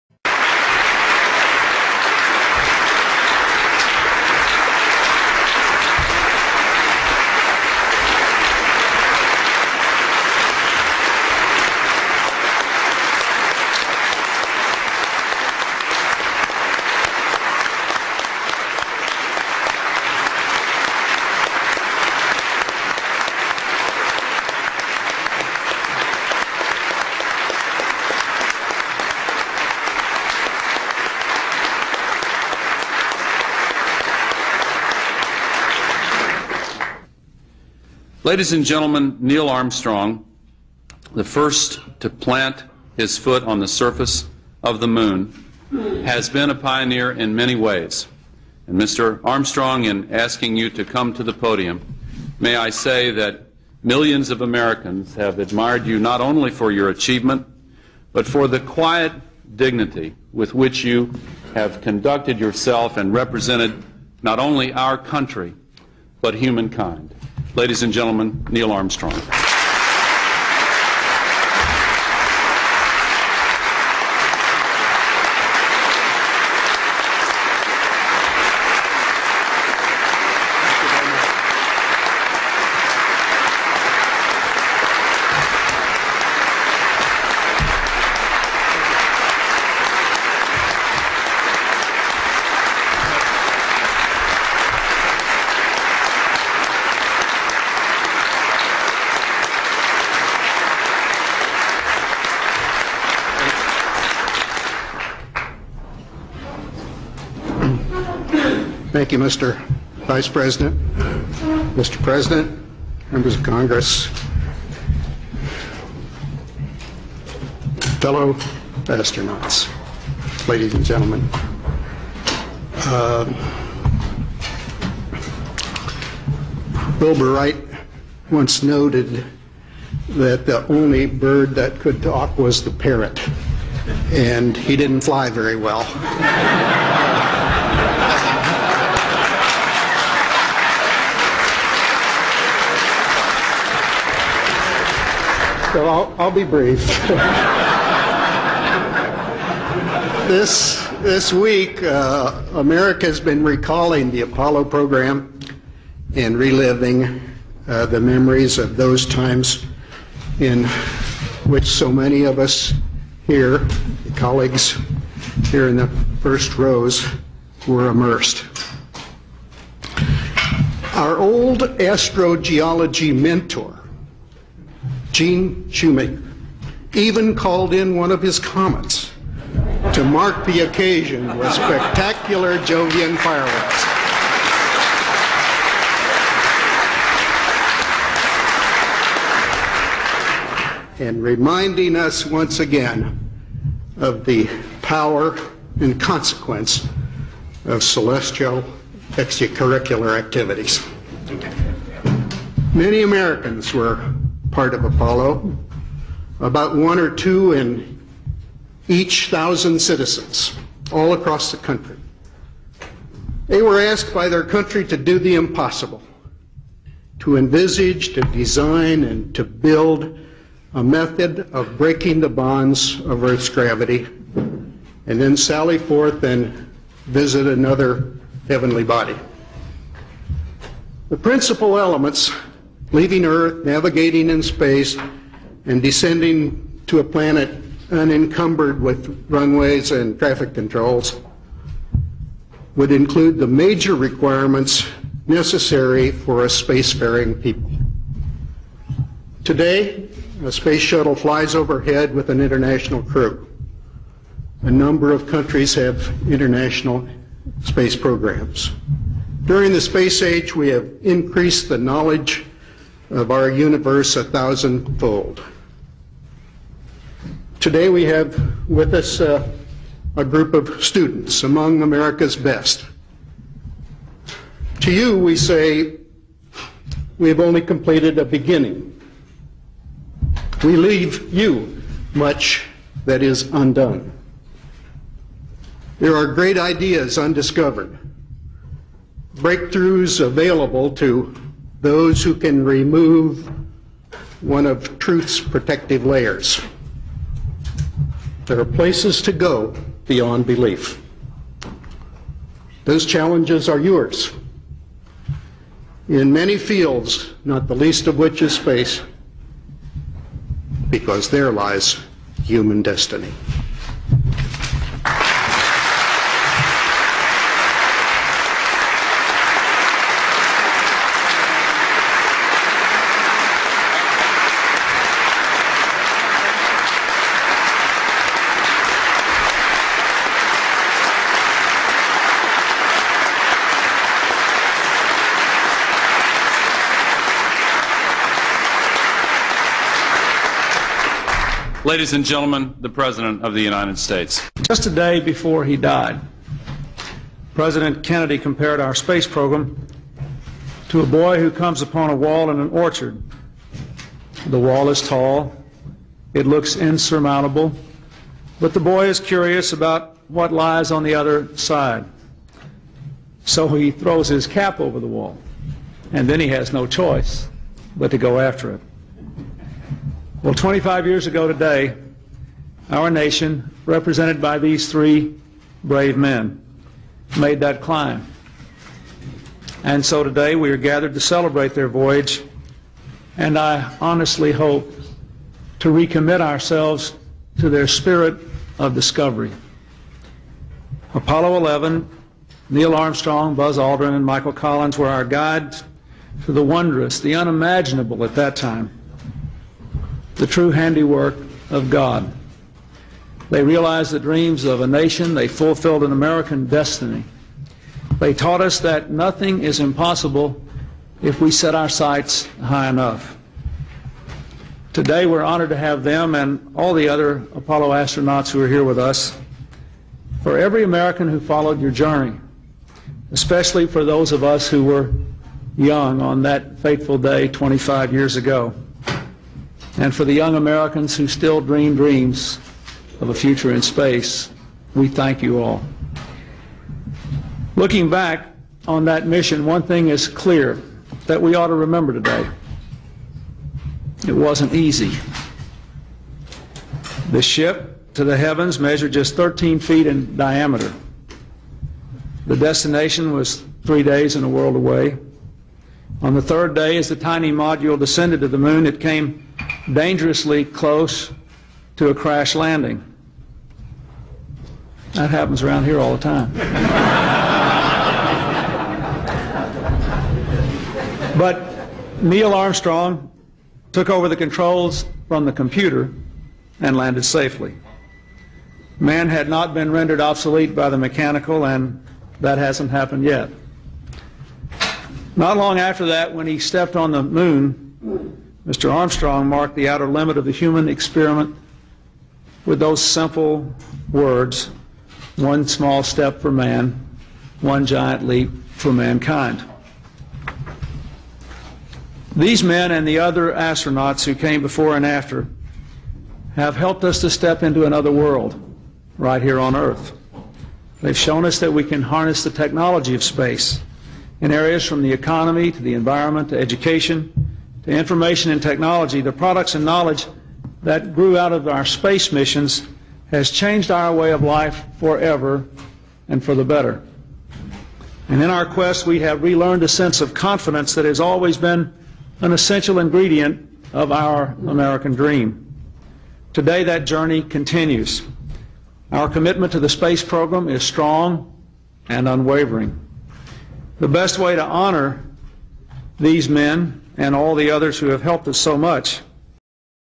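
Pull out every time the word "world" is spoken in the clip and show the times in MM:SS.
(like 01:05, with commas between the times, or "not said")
07:34, 08:28.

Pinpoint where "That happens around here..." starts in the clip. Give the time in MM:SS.
07:45.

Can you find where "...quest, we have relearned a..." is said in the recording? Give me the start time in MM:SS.
08:48.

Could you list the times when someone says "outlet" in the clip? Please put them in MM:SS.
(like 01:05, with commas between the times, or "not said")
not said.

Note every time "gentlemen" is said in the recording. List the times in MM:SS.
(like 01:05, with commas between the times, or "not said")
00:38, 01:07, 02:00, 05:42.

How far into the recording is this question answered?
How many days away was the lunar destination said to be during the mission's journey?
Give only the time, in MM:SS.
07:33.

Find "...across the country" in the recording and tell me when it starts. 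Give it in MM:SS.
03:31.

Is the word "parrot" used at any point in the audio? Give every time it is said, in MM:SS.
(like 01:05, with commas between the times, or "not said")
02:12.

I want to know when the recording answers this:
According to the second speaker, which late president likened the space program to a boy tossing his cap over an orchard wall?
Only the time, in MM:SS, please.
05:47.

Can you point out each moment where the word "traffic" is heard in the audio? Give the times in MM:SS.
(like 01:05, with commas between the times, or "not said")
04:00.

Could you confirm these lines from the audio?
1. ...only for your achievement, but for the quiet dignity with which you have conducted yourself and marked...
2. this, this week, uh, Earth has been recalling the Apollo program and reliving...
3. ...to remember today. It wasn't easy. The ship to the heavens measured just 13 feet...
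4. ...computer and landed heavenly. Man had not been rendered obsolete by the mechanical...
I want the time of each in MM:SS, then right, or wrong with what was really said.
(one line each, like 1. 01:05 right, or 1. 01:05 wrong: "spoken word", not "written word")
1. 00:56 wrong: "represented", not "marked"
2. 02:30 wrong: "America", not "Earth"
3. 07:21 right
4. 07:55 wrong: "safely", not "heavenly".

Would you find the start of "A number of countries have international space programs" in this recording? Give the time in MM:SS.
04:14.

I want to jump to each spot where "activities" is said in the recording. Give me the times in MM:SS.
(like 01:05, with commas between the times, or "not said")
03:20.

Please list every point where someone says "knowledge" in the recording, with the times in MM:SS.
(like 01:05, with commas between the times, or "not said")
04:21, 08:39.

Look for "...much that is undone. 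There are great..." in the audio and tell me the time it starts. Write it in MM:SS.
04:42.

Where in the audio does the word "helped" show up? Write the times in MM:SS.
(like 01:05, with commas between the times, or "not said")
08:26, 09:08.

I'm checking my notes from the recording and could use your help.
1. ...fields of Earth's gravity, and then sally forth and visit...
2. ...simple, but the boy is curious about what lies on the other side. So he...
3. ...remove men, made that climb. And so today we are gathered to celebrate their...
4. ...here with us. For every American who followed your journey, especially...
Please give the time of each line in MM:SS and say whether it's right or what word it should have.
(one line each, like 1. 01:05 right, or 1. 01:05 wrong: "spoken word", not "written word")
1. 03:42 wrong: "bonds", not "fields"
2. 05:56 wrong: "insurmountable", not "simple"
3. 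06:15 wrong: "brave", not "remove"
4. 06:58 right.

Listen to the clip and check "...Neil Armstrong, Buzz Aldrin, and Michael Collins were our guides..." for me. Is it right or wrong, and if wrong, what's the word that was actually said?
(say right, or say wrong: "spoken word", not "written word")
right.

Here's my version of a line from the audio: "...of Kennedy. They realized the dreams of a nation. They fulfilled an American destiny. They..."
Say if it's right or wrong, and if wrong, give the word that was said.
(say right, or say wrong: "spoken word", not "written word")
wrong: "God", not "Kennedy".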